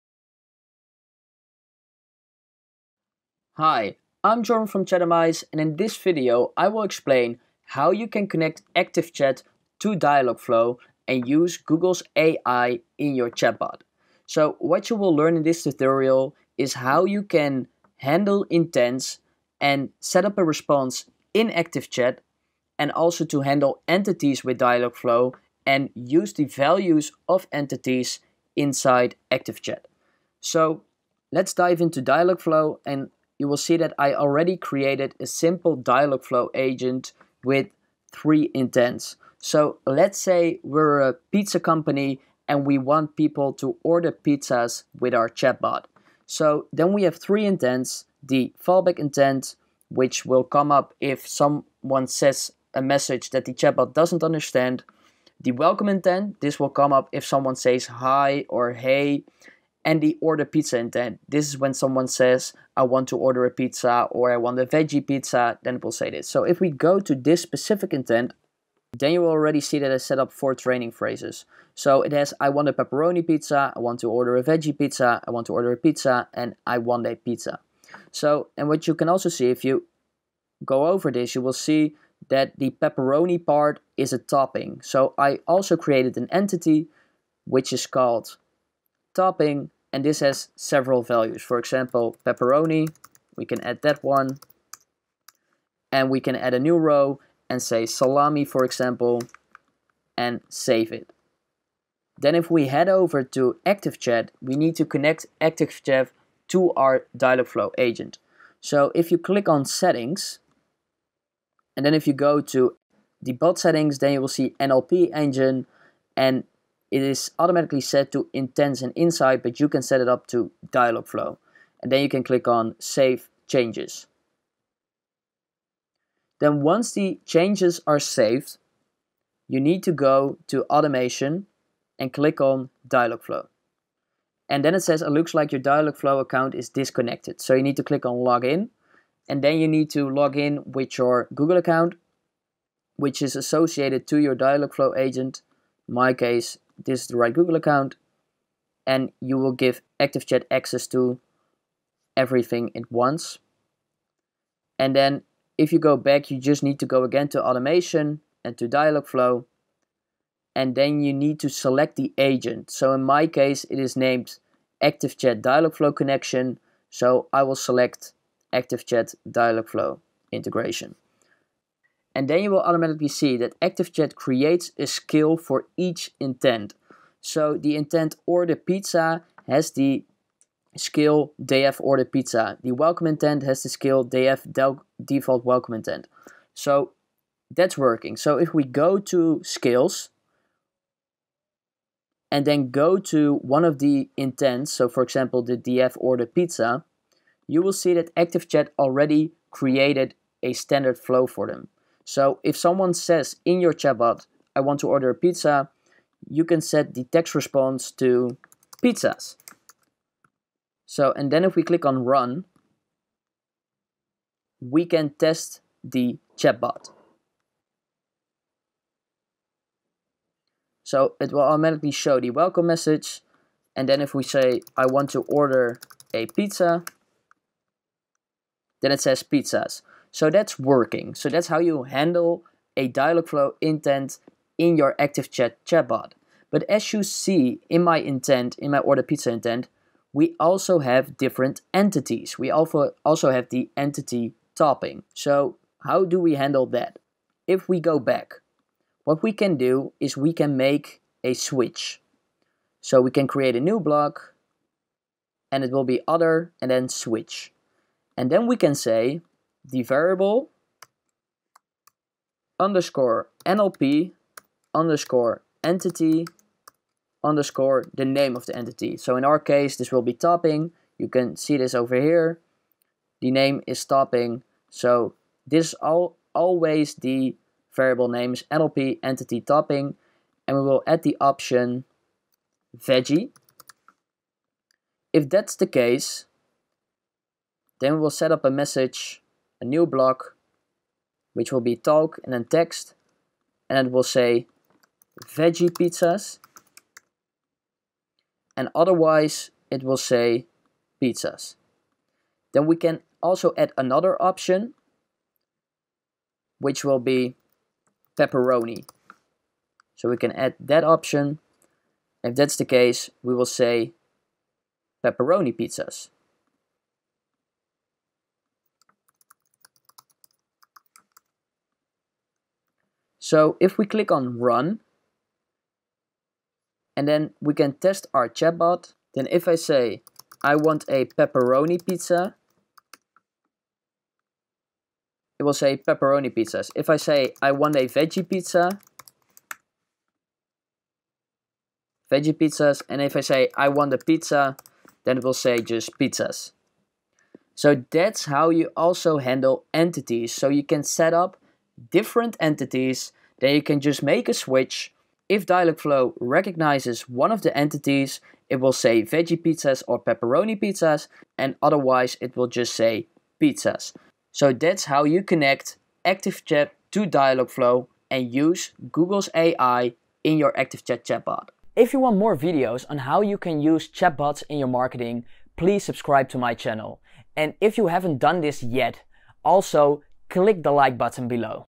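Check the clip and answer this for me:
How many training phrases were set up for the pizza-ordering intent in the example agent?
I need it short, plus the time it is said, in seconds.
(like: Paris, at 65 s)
4, at 70 s.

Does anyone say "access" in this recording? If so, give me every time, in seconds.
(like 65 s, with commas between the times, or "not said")
150 s.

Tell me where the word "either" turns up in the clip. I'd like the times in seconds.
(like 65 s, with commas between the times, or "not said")
not said.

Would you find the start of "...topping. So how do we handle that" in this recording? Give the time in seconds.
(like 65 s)
244 s.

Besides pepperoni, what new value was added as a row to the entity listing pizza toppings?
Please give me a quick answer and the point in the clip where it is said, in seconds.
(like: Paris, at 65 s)
salami, at 97 s.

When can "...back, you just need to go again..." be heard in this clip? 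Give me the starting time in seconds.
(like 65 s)
155 s.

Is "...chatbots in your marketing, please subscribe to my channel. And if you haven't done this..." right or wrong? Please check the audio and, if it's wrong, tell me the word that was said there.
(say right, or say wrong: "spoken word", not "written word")
right.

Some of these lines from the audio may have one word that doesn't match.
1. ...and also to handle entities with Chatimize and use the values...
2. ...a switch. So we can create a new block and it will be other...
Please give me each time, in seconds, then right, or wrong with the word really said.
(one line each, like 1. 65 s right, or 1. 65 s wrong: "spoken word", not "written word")
1. 22 s wrong: "Dialogflow", not "Chatimize"
2. 251 s right.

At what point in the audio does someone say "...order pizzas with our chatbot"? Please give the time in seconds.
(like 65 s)
43 s.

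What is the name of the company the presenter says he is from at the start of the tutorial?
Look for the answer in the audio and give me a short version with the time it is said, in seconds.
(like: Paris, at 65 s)
Chatimize, at 4 s.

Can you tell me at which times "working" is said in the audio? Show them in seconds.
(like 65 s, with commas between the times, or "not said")
187 s, 230 s.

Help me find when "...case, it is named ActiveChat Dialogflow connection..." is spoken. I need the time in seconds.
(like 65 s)
163 s.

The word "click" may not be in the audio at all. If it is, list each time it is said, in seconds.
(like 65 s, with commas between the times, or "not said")
109 s, 122 s, 132 s, 137 s, 211 s, 323 s, 380 s.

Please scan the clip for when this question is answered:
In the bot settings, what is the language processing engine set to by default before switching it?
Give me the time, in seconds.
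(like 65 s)
118 s.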